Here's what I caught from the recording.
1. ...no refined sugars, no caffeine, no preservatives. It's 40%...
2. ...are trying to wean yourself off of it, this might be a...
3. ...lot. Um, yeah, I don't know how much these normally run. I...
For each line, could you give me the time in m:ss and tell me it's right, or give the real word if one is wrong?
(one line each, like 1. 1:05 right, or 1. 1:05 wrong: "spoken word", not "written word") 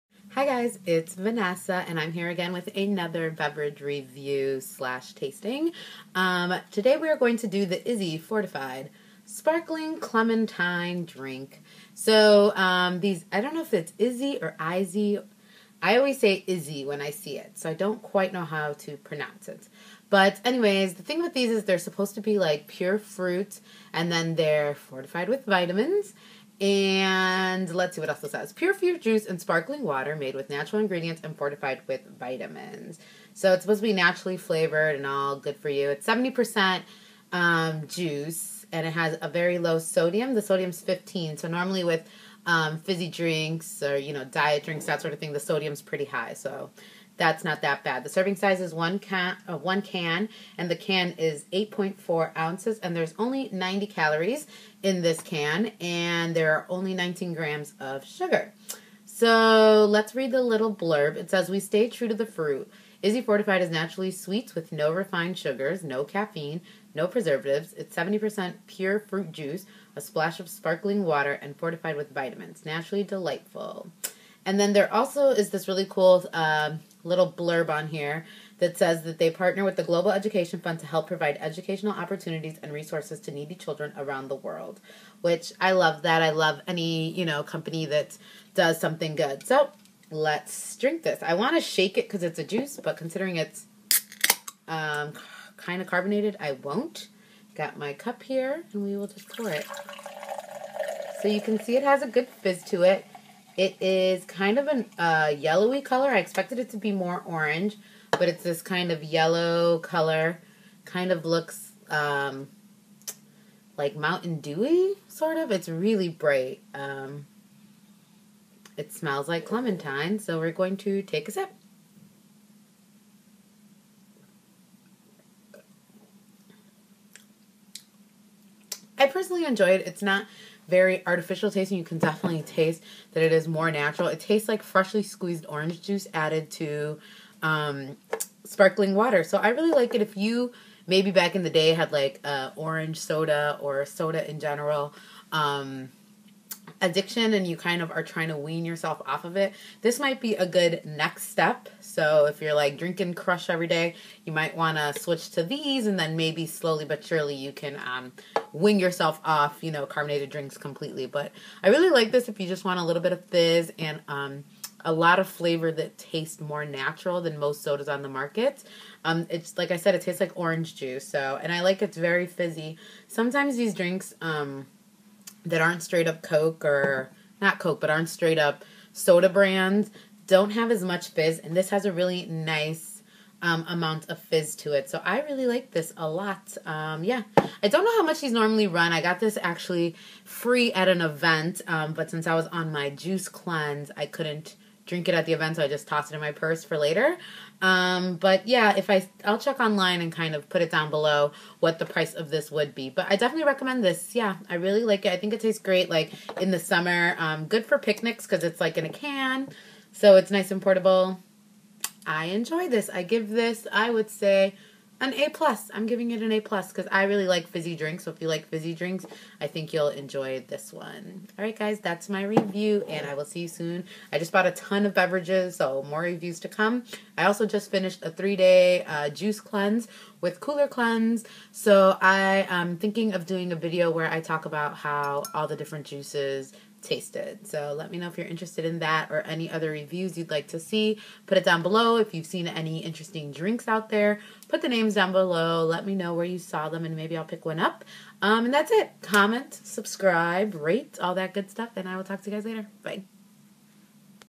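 1. 1:04 wrong: "70", not "40"
2. 2:27 right
3. 3:06 right.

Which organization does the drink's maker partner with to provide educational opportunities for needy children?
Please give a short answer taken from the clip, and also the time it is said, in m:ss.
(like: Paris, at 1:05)
Global Education Fund, at 1:19.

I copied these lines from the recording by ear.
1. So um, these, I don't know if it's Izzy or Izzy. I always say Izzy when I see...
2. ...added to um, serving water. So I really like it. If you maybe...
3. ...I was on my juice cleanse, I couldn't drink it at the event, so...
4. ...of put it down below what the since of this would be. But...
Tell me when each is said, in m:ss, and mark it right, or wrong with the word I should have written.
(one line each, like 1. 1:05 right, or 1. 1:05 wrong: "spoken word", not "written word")
1. 0:11 right
2. 2:16 wrong: "sparkling", not "serving"
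3. 3:12 right
4. 3:20 wrong: "price", not "since".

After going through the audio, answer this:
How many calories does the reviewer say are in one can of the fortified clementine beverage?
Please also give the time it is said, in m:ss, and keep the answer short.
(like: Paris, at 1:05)
90, at 0:53.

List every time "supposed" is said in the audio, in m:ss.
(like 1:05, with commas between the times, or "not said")
0:21, 0:33.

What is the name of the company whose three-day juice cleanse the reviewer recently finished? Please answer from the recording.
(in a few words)
Cooler Cleanse.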